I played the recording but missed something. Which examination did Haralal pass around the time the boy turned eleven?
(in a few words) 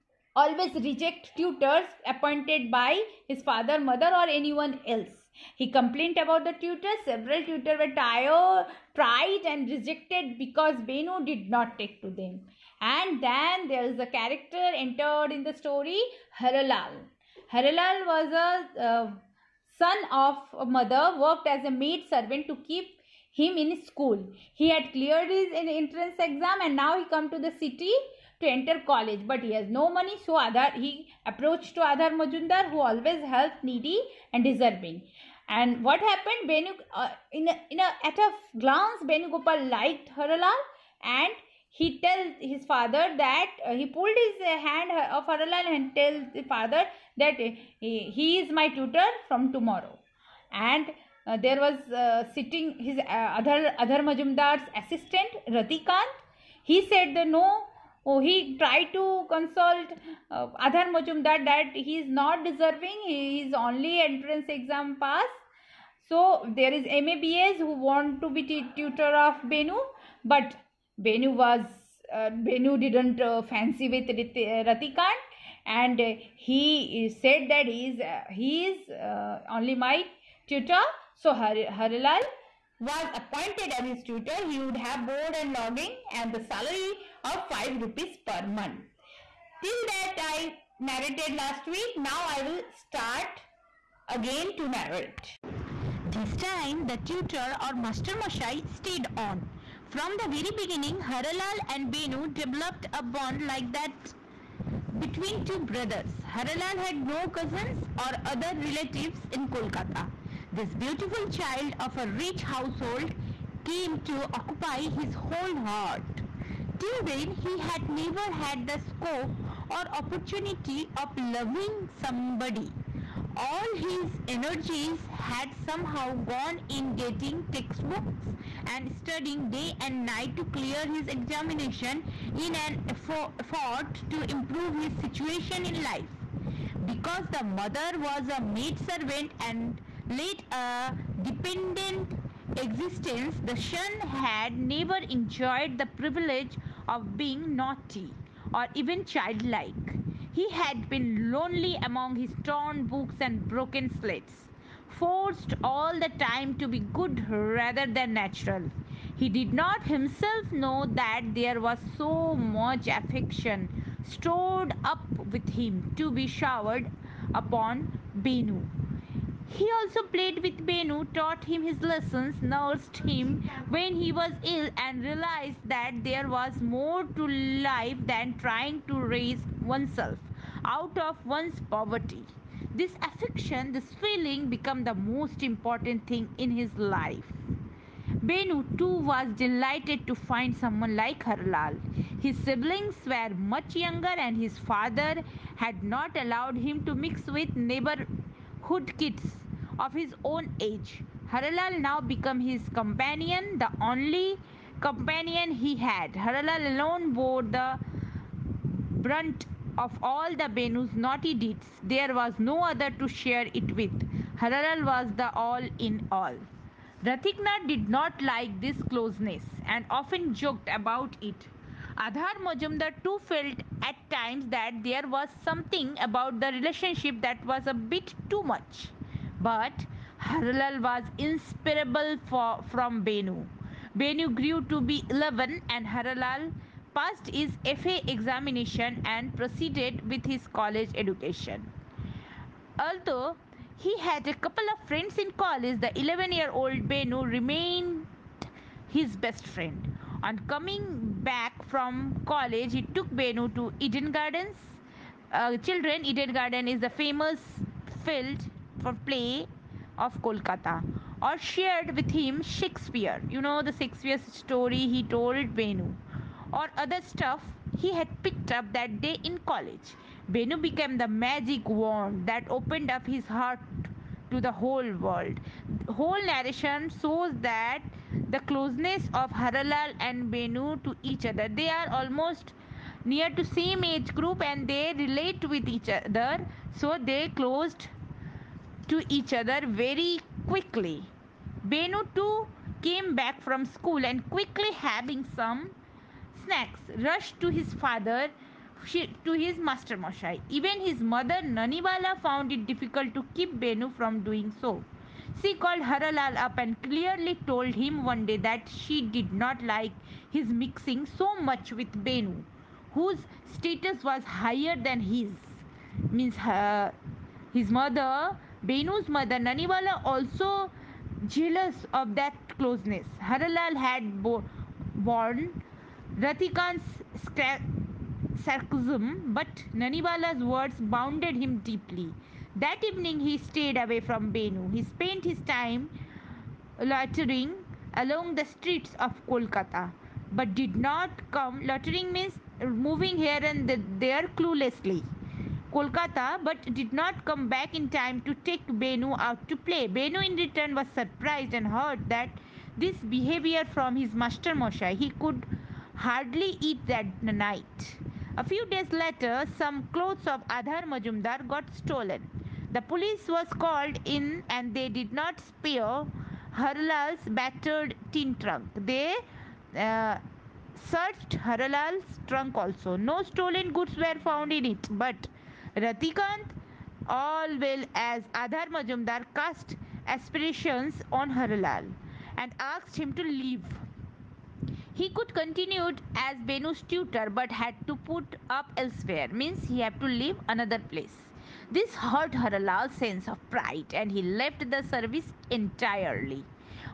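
FA examination.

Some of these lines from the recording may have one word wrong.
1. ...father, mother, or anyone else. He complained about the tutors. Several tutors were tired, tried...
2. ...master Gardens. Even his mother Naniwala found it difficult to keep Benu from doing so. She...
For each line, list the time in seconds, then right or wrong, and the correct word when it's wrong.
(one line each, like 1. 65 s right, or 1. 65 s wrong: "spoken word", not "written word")
1. 3 s right
2. 299 s wrong: "Moshai", not "Gardens".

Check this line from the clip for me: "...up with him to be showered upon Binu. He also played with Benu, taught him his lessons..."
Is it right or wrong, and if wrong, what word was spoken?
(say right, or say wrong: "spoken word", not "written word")
right.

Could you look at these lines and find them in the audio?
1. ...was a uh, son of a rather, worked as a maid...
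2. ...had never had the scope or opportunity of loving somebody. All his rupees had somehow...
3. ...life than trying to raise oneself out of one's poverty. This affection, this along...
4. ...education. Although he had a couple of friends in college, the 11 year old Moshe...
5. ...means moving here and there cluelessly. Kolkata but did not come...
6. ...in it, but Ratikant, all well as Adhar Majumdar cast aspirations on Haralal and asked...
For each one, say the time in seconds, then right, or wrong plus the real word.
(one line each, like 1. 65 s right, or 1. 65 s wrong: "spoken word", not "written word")
1. 18 s wrong: "mother", not "rather"
2. 117 s wrong: "energies", not "rupees"
3. 177 s wrong: "feeling", not "along"
4. 240 s wrong: "Benu", not "Moshe"
5. 342 s right
6. 374 s right.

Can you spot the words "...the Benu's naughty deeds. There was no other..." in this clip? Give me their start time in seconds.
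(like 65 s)
210 s.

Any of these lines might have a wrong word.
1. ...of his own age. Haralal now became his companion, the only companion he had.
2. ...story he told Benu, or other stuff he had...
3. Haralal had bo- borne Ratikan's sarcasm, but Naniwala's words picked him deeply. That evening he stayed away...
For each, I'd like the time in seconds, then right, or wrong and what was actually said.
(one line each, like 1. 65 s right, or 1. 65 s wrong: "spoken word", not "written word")
1. 199 s right
2. 264 s right
3. 323 s wrong: "bounded", not "picked".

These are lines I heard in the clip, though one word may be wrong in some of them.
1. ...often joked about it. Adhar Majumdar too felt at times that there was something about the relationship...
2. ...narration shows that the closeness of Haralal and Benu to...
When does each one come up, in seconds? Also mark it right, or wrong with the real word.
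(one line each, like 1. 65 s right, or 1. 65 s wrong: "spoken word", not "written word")
1. 219 s right
2. 276 s right.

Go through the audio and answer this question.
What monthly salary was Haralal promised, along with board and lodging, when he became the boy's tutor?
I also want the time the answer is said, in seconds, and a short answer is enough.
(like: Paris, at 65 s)
5 rupees, at 87 s.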